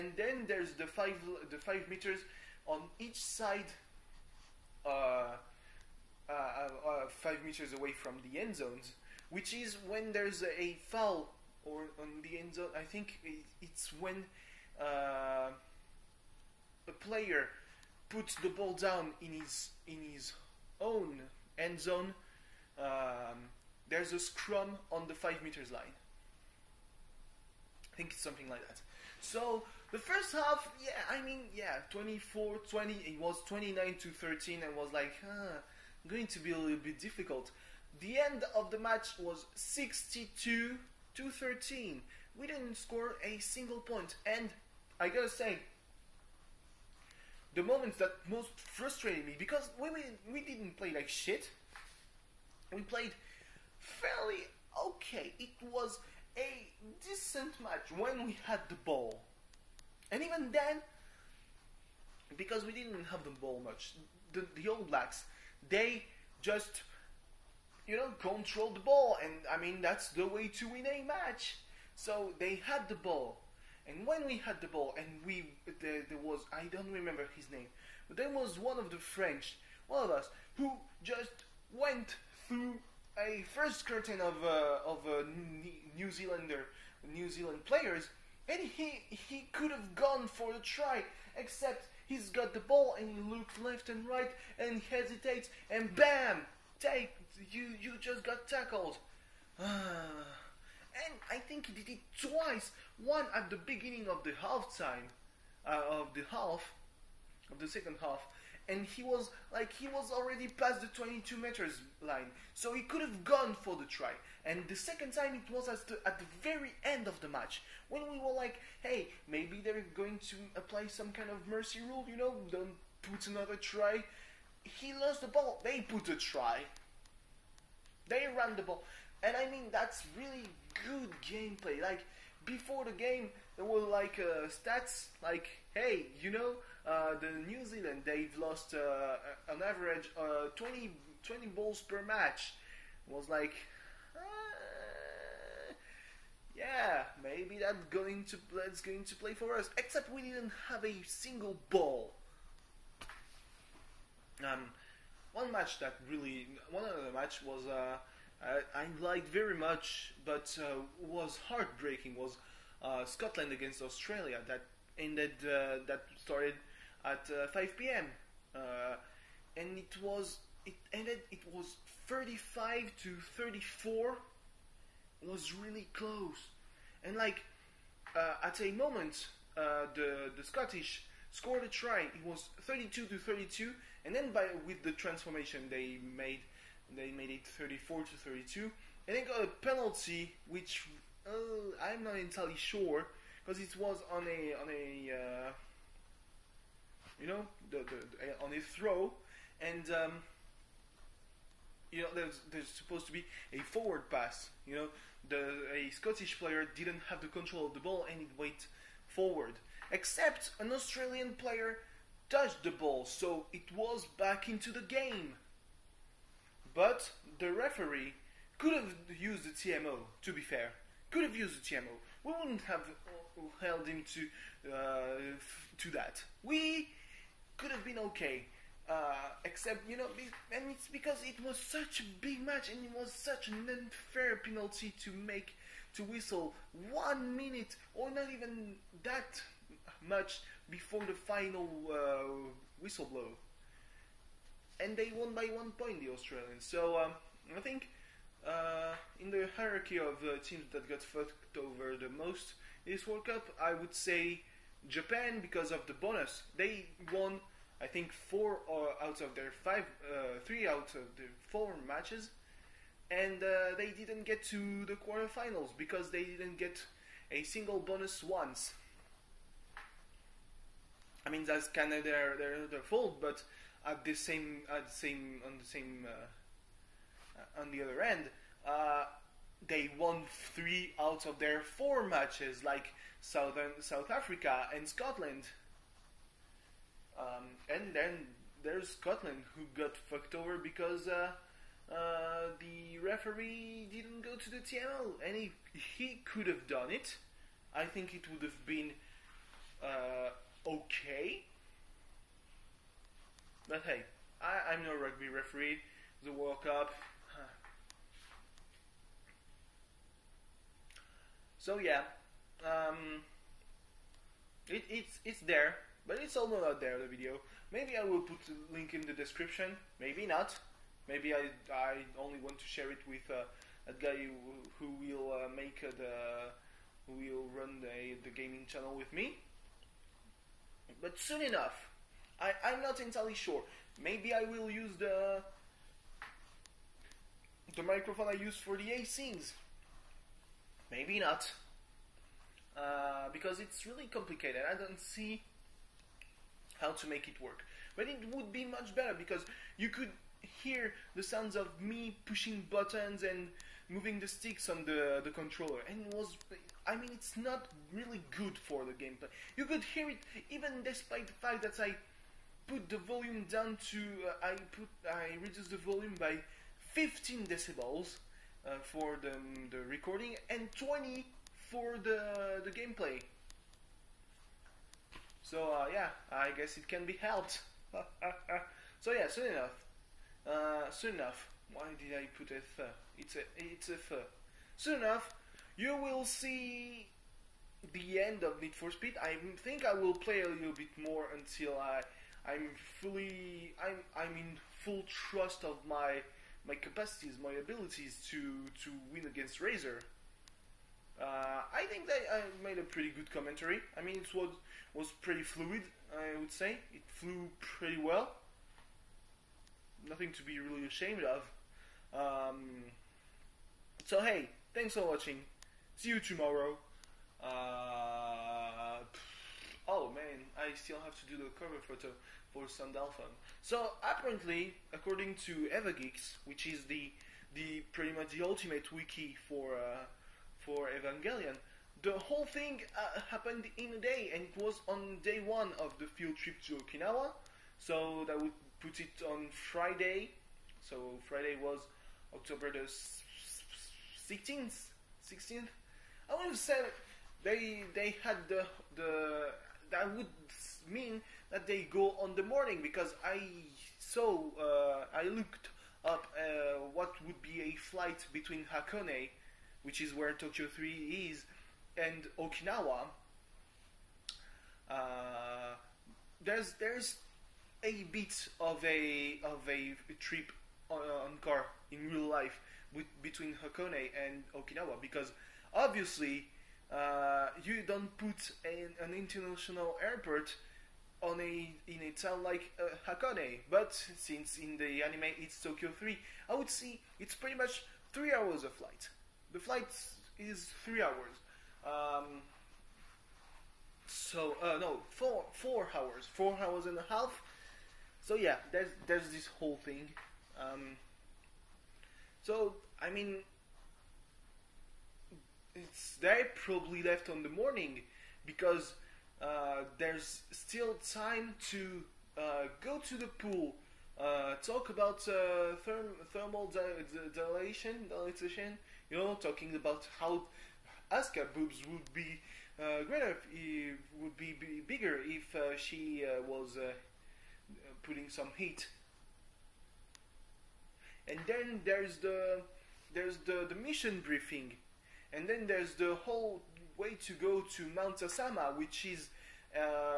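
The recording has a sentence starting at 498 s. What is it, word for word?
So yeah, there's there's this whole thing.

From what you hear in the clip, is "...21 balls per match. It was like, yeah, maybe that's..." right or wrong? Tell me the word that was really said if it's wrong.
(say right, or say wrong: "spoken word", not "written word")
wrong: "20", not "21".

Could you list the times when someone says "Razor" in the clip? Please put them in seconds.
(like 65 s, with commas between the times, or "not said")
399 s.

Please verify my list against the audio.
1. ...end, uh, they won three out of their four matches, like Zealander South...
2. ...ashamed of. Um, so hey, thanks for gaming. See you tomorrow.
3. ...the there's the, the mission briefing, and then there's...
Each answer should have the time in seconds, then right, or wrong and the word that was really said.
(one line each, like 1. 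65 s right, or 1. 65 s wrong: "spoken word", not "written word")
1. 278 s wrong: "Southern", not "Zealander"
2. 410 s wrong: "watching", not "gaming"
3. 532 s right.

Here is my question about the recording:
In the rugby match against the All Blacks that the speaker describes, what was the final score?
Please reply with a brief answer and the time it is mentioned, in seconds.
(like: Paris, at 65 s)
62 to 13, at 39 s.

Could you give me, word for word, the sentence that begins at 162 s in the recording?
Was uh, Scotland against Australia that ended uh, that started at uh, 5 p.m.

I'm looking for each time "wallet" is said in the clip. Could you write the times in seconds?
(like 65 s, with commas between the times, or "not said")
not said.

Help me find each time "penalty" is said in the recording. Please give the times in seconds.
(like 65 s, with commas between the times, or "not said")
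189 s, 234 s.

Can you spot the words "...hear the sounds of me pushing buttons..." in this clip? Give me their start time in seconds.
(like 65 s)
350 s.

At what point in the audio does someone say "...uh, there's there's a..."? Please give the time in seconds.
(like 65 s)
464 s.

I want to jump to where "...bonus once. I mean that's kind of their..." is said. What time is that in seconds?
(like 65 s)
267 s.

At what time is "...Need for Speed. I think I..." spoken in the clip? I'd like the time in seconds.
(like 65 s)
388 s.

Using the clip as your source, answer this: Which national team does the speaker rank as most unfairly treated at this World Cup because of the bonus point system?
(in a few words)
Japan.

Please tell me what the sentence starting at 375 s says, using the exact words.
So uh, yeah, I guess it can be helped.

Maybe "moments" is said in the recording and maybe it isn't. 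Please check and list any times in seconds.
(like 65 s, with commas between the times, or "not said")
47 s, 178 s.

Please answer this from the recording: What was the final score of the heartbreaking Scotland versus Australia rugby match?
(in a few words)
35 to 34.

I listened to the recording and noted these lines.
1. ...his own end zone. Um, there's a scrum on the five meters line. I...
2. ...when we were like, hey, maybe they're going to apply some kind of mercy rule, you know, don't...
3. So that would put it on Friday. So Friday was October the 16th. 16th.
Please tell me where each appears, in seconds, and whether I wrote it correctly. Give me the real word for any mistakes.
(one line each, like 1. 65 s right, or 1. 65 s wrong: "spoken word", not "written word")
1. 20 s right
2. 117 s right
3. 437 s right.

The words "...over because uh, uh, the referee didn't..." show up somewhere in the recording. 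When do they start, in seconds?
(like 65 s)
290 s.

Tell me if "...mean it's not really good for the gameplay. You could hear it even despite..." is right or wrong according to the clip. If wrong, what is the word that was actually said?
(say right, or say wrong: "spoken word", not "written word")
right.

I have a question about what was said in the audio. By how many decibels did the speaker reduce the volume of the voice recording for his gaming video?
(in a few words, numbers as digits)
15.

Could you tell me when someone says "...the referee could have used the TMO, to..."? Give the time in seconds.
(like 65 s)
217 s.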